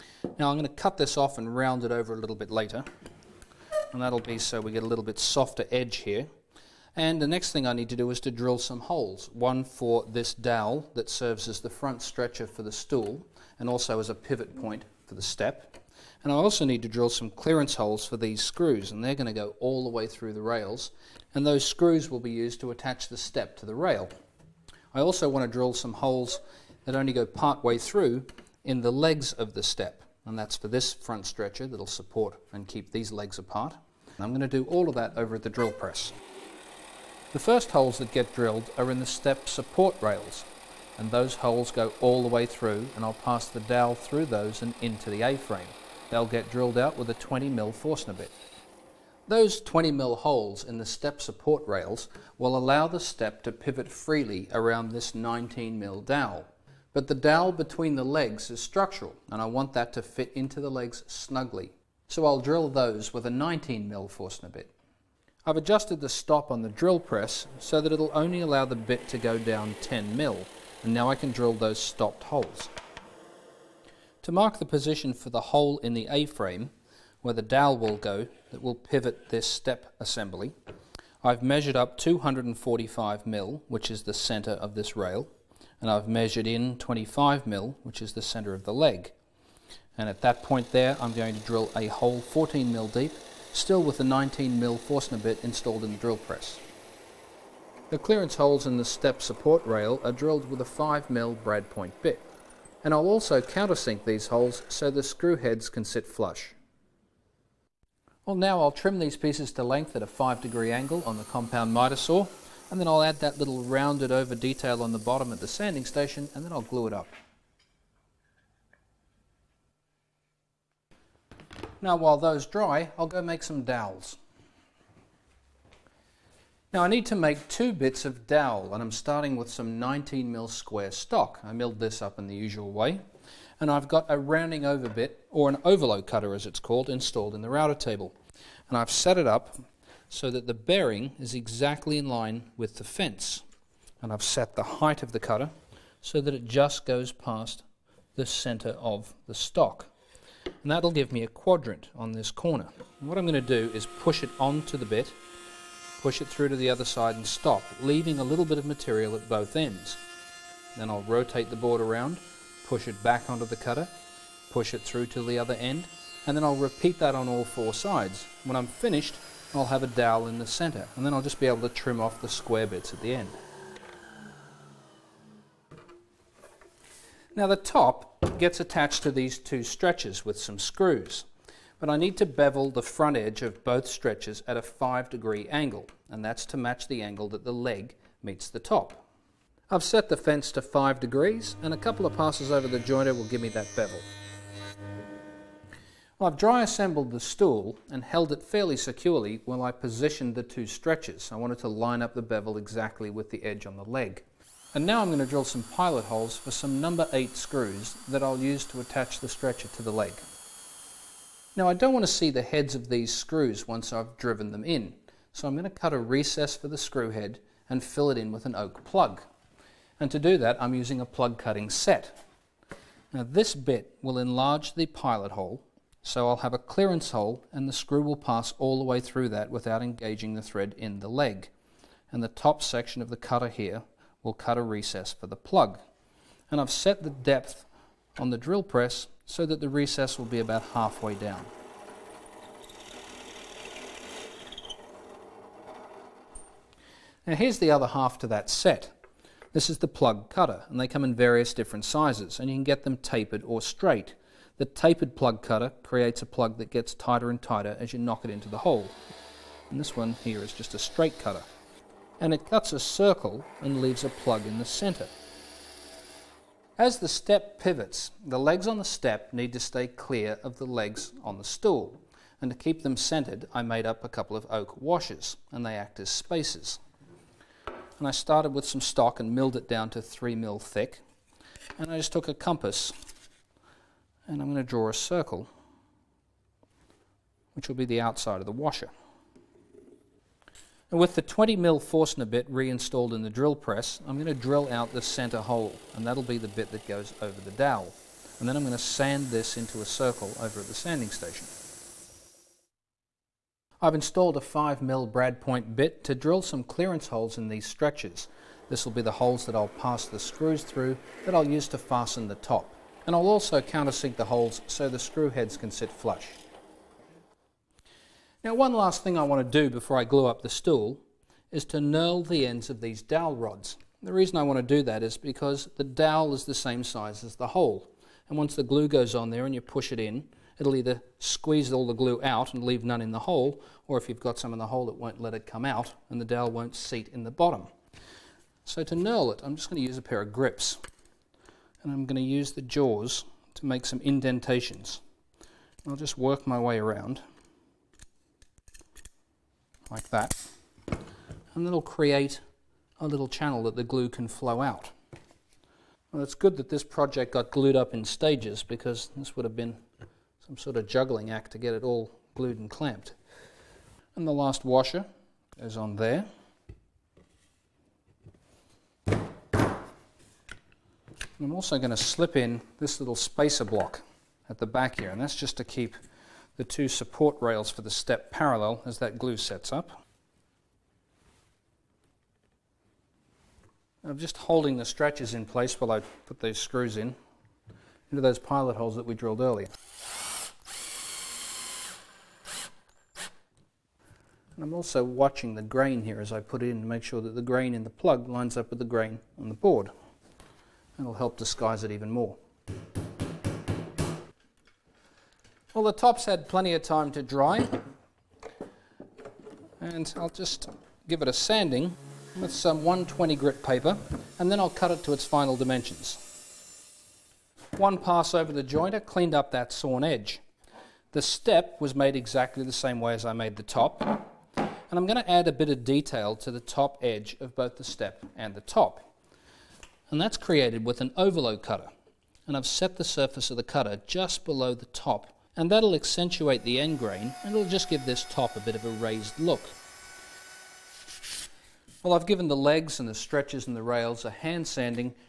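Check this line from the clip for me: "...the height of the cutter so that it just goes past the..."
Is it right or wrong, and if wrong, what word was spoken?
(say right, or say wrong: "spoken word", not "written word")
right.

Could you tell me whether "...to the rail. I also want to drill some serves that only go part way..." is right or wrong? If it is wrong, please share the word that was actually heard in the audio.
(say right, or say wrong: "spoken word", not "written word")
wrong: "holes", not "serves".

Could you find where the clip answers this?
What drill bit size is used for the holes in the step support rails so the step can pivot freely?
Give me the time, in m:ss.
0:47.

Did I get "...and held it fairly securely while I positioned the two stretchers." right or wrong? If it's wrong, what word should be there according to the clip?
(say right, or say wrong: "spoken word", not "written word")
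right.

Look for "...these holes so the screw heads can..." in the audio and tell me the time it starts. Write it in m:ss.
1:44.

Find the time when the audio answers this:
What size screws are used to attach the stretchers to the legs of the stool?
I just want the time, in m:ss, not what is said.
3:26.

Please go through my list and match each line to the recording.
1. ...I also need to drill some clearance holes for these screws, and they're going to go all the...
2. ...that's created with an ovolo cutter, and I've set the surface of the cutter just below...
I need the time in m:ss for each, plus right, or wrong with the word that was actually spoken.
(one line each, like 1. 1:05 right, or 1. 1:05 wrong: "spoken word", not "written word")
1. 0:16 right
2. 7:10 right.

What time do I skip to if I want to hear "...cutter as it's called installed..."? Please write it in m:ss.
2:16.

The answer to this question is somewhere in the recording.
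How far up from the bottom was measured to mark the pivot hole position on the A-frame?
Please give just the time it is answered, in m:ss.
1:21.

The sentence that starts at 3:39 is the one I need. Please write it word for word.
And to do that I'm using a plug cutting set.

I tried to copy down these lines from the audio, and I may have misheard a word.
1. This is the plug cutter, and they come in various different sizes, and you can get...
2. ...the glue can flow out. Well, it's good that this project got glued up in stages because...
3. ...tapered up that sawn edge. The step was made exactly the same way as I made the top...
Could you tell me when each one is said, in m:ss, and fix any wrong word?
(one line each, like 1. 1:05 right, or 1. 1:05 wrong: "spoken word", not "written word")
1. 4:09 right
2. 5:53 right
3. 6:59 wrong: "cleaned", not "tapered".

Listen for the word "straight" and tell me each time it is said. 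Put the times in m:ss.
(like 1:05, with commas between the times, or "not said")
4:13, 4:20.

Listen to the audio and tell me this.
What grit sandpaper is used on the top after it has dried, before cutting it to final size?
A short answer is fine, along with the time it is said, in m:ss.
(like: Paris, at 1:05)
120 grit, at 6:52.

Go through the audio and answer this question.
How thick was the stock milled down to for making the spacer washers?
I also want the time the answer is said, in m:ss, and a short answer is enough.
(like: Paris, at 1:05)
3 mm, at 4:39.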